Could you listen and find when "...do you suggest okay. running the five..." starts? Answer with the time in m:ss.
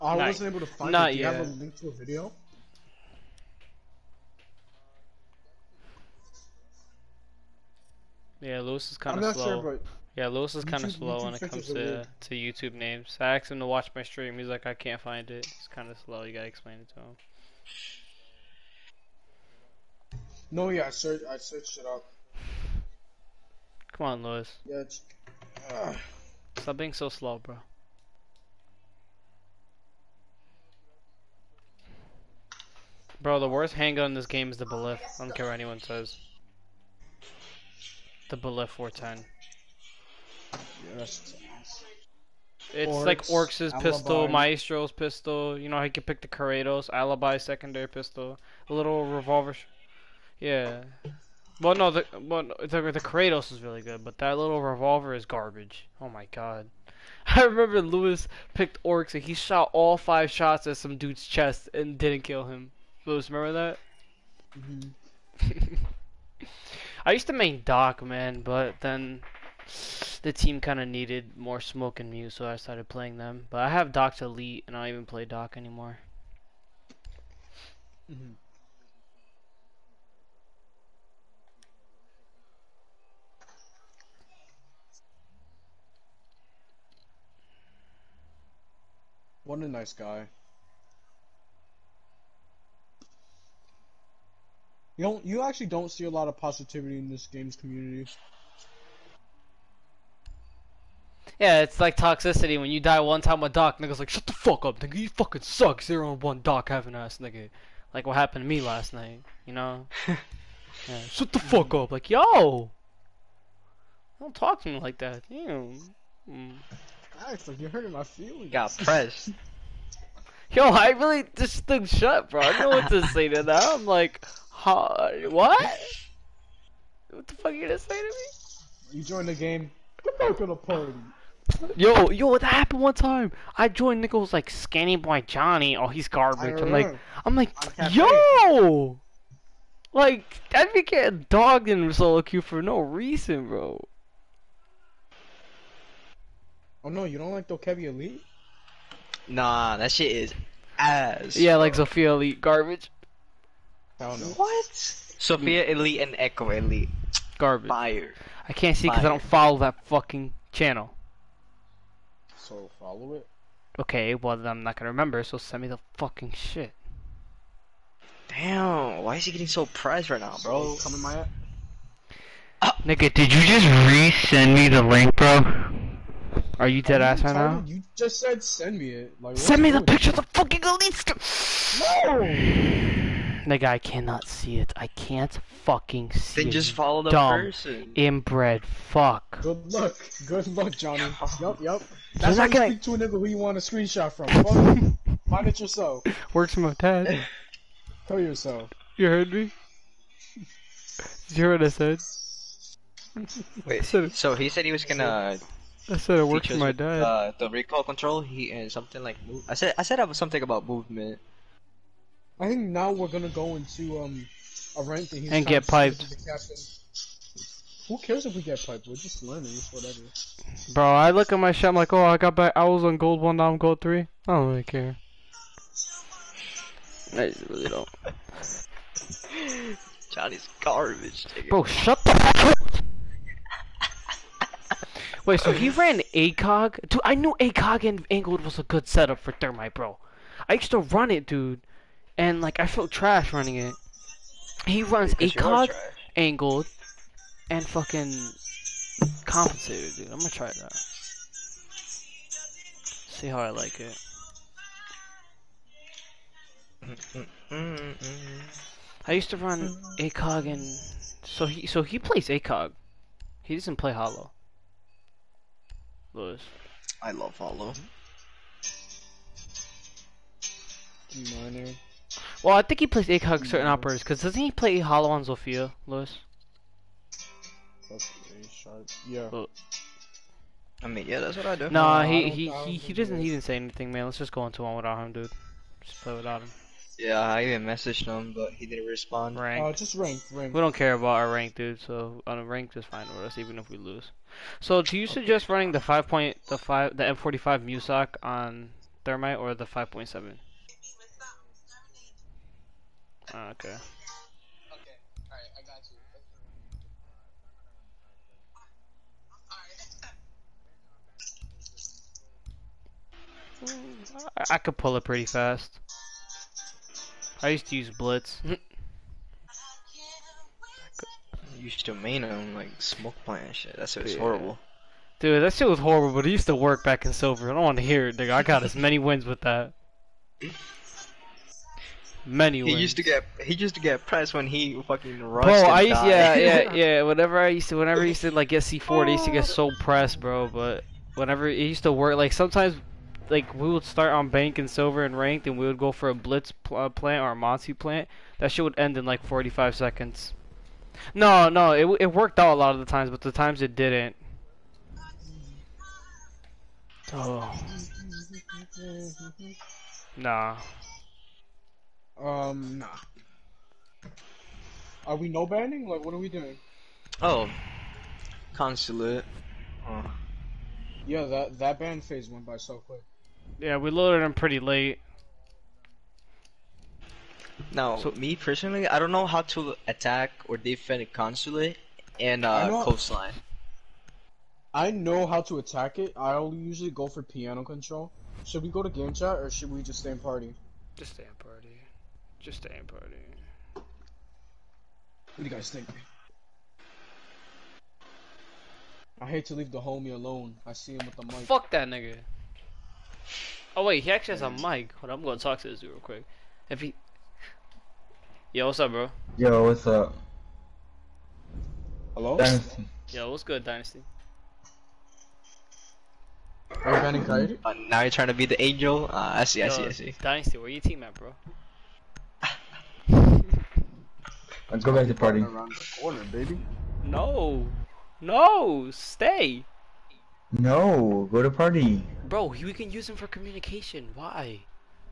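4:54.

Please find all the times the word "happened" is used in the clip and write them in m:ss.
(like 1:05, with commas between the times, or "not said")
1:48, 2:12.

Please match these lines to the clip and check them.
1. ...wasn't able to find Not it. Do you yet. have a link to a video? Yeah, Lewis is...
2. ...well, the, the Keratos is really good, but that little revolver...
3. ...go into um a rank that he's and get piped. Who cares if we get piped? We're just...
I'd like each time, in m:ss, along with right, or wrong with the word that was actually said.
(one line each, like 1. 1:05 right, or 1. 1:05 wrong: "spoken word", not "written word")
1. 0:00 right
2. 0:52 right
3. 3:33 right.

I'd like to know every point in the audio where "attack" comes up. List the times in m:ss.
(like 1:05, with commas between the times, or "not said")
6:19, 6:25.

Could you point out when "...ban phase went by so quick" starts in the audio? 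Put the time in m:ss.
6:11.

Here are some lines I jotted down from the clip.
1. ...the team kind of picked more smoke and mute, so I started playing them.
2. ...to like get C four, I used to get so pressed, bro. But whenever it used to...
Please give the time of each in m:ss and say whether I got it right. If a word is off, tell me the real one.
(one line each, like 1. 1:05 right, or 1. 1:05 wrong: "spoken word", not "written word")
1. 1:10 wrong: "needed", not "picked"
2. 5:38 right.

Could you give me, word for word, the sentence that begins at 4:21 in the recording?
So he, so he plays ACOG.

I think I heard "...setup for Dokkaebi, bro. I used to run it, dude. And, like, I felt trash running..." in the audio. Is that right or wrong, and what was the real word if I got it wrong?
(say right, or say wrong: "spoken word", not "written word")
wrong: "Thermite", not "Dokkaebi".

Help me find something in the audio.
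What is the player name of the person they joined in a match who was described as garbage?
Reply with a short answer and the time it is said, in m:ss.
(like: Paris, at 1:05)
SkinnyBoyJohnny, at 2:14.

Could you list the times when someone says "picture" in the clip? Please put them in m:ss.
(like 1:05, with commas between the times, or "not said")
2:59.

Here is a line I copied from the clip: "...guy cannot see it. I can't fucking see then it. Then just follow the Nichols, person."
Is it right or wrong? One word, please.
wrong.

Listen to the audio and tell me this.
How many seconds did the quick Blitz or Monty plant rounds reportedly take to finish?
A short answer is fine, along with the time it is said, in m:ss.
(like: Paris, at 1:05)
45, at 5:49.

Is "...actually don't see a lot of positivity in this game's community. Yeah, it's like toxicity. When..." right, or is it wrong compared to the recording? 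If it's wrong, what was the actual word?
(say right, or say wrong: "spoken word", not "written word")
right.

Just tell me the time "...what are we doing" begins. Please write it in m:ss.
6:06.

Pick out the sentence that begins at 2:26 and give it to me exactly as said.
Oh no, you don't like Dokkaebi Elite?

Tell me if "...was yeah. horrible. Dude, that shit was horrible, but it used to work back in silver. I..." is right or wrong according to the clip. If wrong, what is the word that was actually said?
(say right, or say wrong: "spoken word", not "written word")
right.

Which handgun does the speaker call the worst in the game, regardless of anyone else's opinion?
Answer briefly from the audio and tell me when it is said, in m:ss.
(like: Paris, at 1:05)
Bailiff 410, at 0:38.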